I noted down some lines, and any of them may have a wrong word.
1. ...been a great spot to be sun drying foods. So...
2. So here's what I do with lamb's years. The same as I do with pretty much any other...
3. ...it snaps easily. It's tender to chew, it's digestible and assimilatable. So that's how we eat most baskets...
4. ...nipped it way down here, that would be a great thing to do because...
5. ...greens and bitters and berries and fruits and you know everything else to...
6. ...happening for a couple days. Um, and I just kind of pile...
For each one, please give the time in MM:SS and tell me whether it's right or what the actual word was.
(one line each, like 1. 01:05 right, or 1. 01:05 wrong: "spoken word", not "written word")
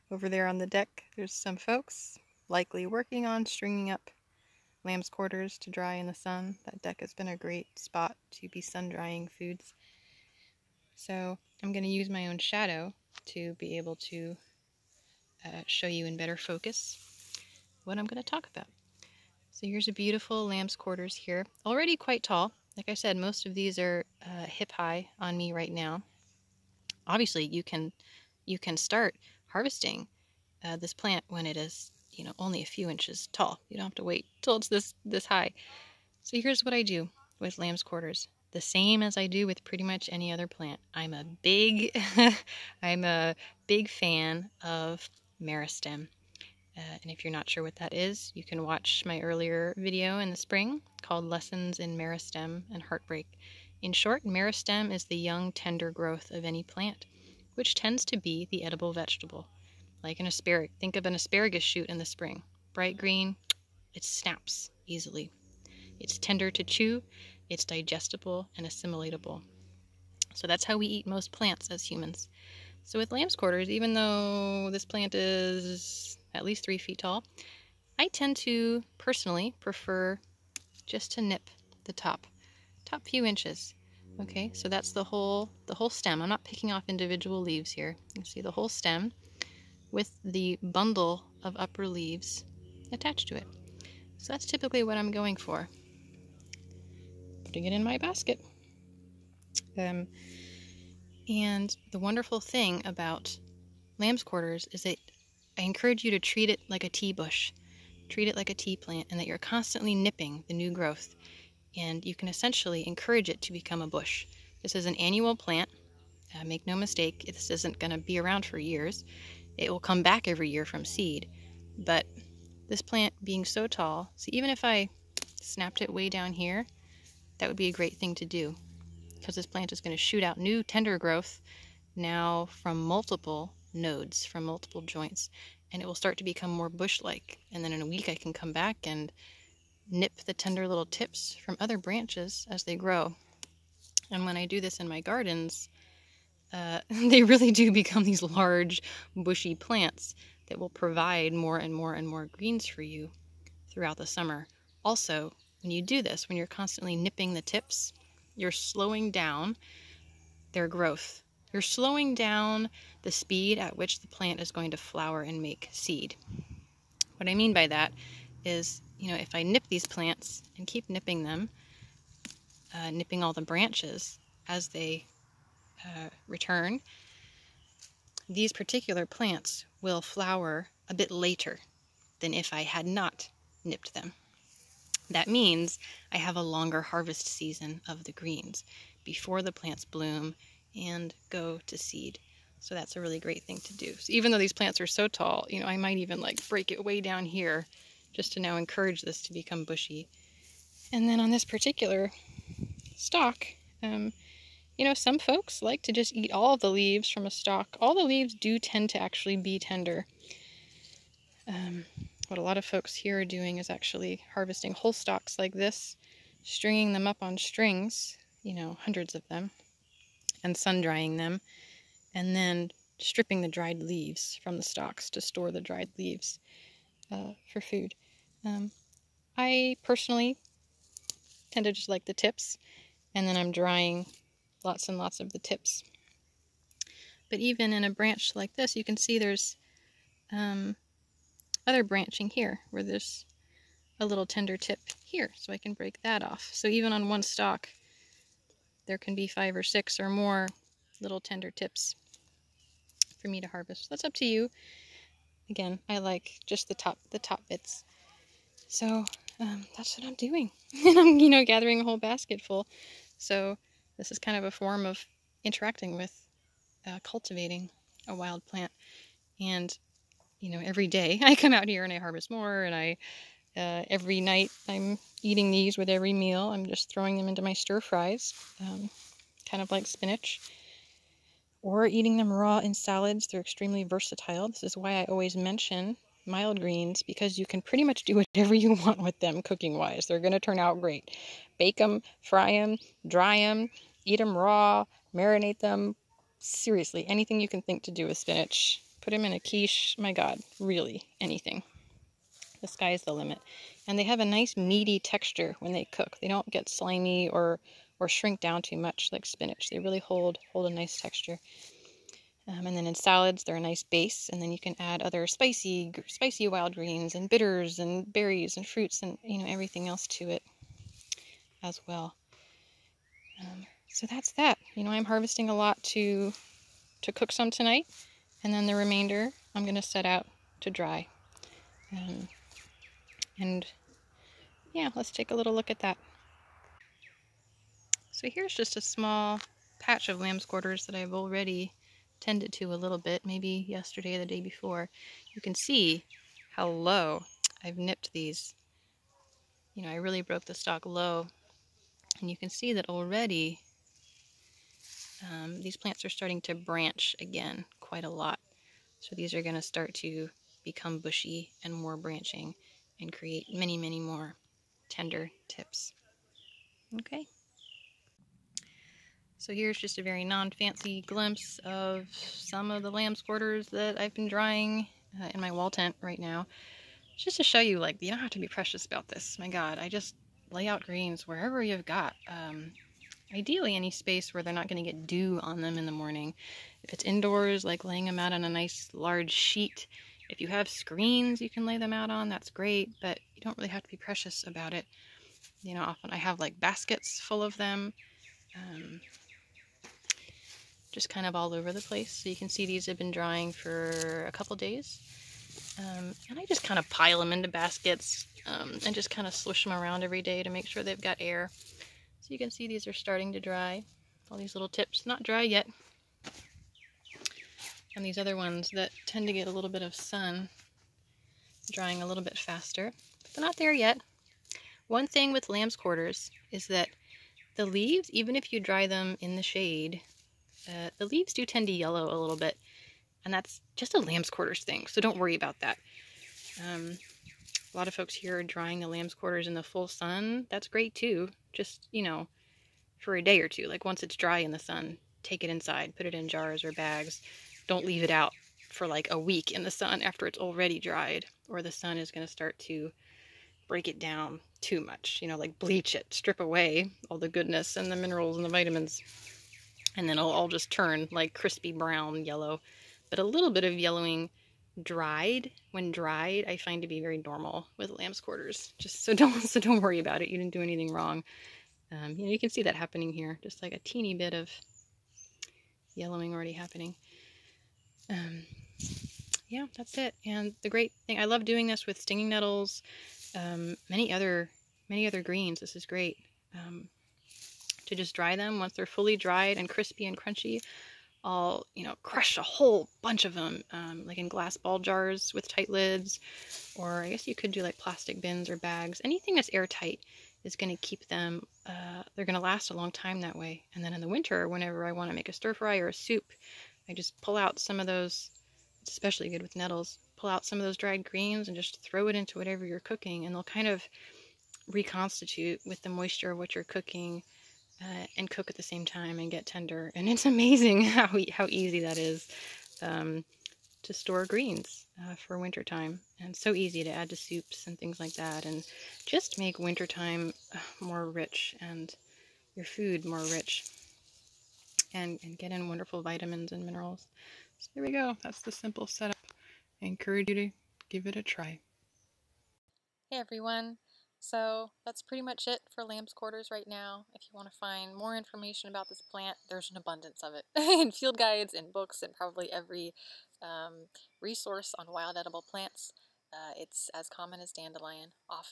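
1. 00:07 right
2. 00:36 wrong: "quarters", not "years"
3. 01:03 wrong: "plants", not "baskets"
4. 02:05 wrong: "snapped", not "nipped"
5. 05:16 right
6. 06:43 wrong: "drying", not "happening".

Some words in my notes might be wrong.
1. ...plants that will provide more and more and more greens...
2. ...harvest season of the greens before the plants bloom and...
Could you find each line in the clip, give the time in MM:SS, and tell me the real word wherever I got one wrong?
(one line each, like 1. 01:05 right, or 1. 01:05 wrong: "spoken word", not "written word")
1. 02:29 right
2. 03:06 right.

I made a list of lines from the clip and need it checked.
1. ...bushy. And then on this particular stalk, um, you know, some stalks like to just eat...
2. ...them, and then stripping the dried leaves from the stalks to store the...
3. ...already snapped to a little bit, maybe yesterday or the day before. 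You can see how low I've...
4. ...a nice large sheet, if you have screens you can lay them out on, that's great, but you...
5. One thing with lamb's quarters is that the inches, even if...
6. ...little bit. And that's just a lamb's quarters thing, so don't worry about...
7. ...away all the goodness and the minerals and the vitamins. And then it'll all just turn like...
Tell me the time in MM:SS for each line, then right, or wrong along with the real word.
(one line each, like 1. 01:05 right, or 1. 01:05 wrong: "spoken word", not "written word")
1. 03:19 wrong: "folks", not "stalks"
2. 03:41 right
3. 05:41 wrong: "tended", not "snapped"
4. 06:28 right
5. 07:04 wrong: "leaves", not "inches"
6. 07:12 right
7. 07:36 right.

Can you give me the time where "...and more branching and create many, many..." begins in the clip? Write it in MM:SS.
06:01.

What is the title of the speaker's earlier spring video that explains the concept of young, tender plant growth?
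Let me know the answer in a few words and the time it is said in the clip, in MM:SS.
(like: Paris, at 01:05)
Lessons in Meristem and Heartbreak, at 00:51.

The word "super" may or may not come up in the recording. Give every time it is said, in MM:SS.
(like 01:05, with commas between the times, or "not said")
not said.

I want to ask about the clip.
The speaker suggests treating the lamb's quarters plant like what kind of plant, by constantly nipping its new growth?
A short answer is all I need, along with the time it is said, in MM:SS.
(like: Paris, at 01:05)
A tea bush, at 01:46.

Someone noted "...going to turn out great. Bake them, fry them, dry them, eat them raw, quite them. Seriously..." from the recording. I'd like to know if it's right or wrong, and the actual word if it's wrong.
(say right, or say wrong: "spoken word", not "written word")
wrong: "marinate", not "quite".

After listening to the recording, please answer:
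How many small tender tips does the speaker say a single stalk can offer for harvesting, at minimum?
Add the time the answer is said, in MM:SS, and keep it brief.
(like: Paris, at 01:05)
5 or 6, at 04:09.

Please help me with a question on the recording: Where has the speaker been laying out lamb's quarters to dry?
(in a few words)
Wall tent.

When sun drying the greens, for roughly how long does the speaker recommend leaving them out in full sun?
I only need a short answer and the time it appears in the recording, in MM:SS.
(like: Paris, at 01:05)
A day or two, at 07:23.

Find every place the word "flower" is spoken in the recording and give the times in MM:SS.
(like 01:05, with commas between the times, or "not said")
02:44, 03:00.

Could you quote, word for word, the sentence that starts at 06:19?
My God, I just lay out greens wherever you've got.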